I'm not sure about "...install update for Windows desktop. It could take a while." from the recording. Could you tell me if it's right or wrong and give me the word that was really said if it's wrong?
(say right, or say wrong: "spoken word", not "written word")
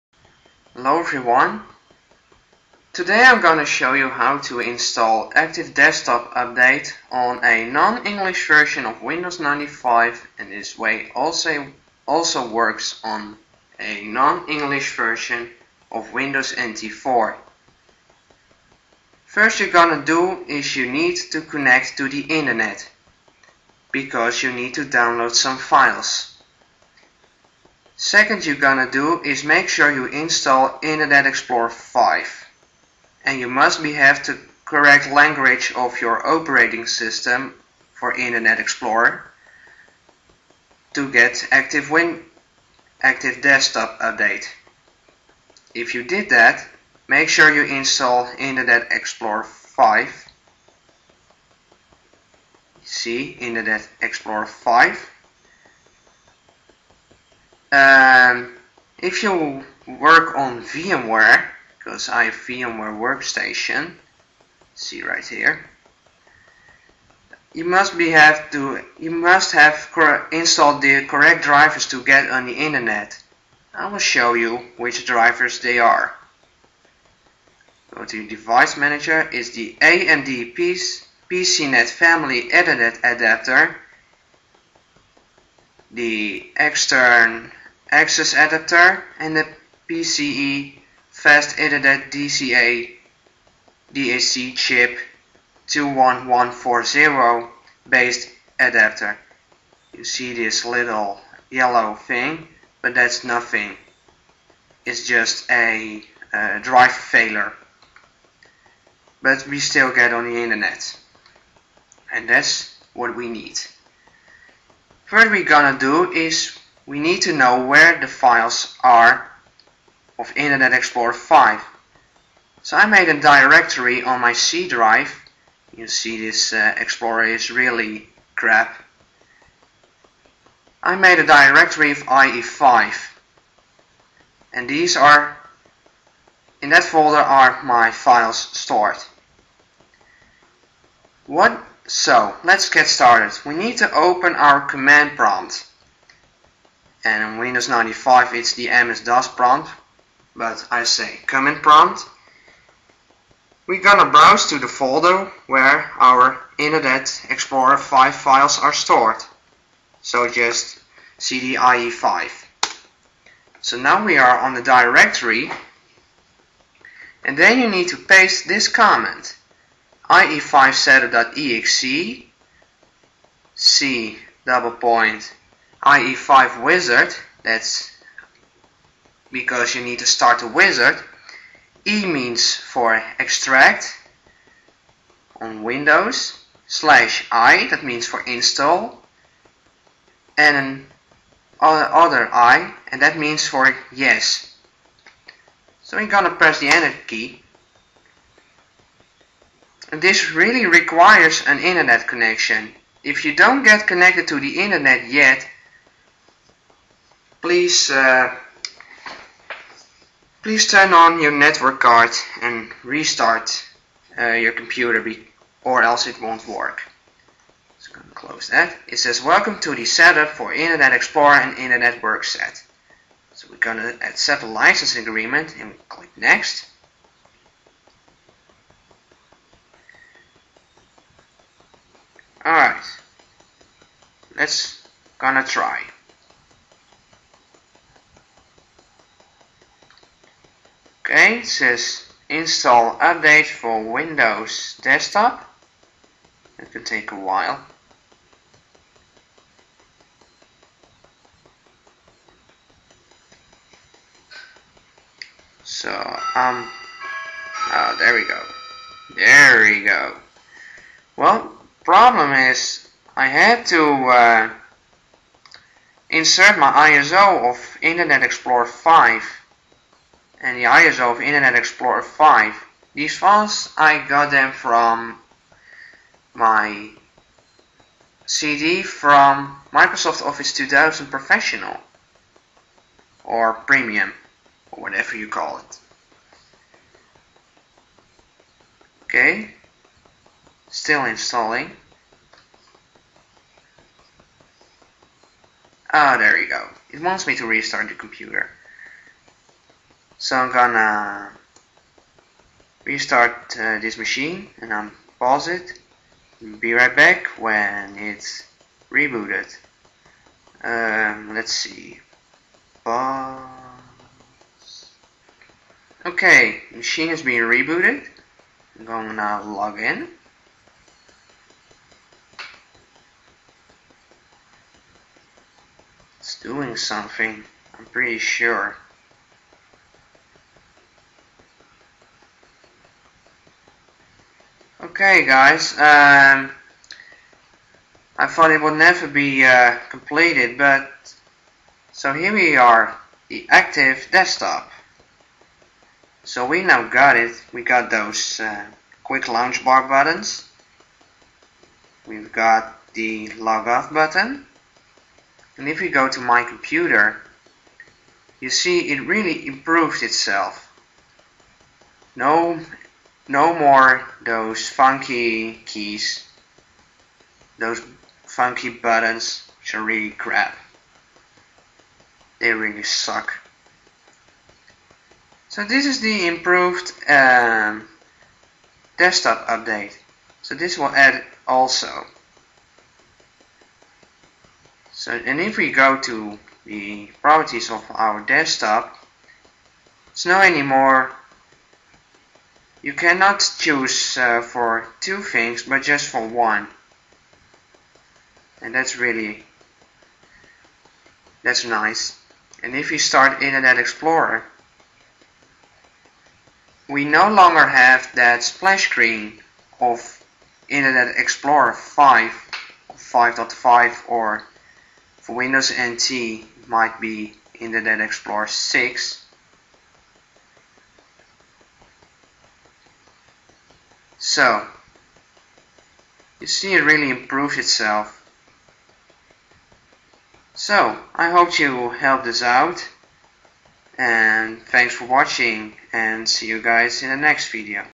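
right.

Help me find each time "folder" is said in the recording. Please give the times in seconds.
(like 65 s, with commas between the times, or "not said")
136 s, 154 s.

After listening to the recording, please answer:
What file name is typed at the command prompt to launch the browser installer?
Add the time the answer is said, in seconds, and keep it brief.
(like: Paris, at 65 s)
ie5setup.exe, at 170 s.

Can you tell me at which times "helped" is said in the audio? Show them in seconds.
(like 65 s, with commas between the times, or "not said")
431 s.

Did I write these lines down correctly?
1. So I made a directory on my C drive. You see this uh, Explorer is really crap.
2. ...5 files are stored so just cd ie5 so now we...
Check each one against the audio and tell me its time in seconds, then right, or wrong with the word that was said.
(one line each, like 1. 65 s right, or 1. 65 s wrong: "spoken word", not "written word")
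1. 122 s right
2. 157 s right.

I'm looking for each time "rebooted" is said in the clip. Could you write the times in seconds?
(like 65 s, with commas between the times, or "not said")
308 s, 317 s.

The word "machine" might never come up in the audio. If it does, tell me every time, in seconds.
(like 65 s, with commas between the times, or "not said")
303 s, 316 s.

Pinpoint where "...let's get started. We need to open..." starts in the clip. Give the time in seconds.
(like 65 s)
142 s.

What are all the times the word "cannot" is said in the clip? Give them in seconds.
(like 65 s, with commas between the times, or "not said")
392 s.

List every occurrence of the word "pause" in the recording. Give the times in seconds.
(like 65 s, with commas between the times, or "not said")
305 s, 312 s.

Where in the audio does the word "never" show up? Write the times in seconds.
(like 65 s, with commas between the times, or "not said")
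338 s.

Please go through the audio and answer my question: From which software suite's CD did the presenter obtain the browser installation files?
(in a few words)
Microsoft Office 2000.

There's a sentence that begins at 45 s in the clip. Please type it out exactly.
If you did that, make sure you install Internet Explorer 5.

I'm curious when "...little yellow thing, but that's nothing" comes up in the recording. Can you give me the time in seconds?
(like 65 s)
100 s.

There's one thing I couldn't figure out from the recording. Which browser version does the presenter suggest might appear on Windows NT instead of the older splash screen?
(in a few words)
Internet Explorer 6.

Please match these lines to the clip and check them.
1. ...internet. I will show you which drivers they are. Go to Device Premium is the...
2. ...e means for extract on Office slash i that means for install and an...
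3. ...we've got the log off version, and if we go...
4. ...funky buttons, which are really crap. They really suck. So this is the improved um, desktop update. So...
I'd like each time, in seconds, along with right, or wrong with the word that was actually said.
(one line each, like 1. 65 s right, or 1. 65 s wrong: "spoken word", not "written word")
1. 72 s wrong: "Manager", not "Premium"
2. 181 s wrong: "Windows", not "Office"
3. 352 s wrong: "button", not "version"
4. 368 s right.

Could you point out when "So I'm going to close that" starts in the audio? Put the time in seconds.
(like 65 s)
217 s.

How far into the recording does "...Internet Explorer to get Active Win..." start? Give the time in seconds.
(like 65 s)
38 s.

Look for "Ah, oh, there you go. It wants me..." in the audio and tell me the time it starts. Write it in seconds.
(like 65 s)
295 s.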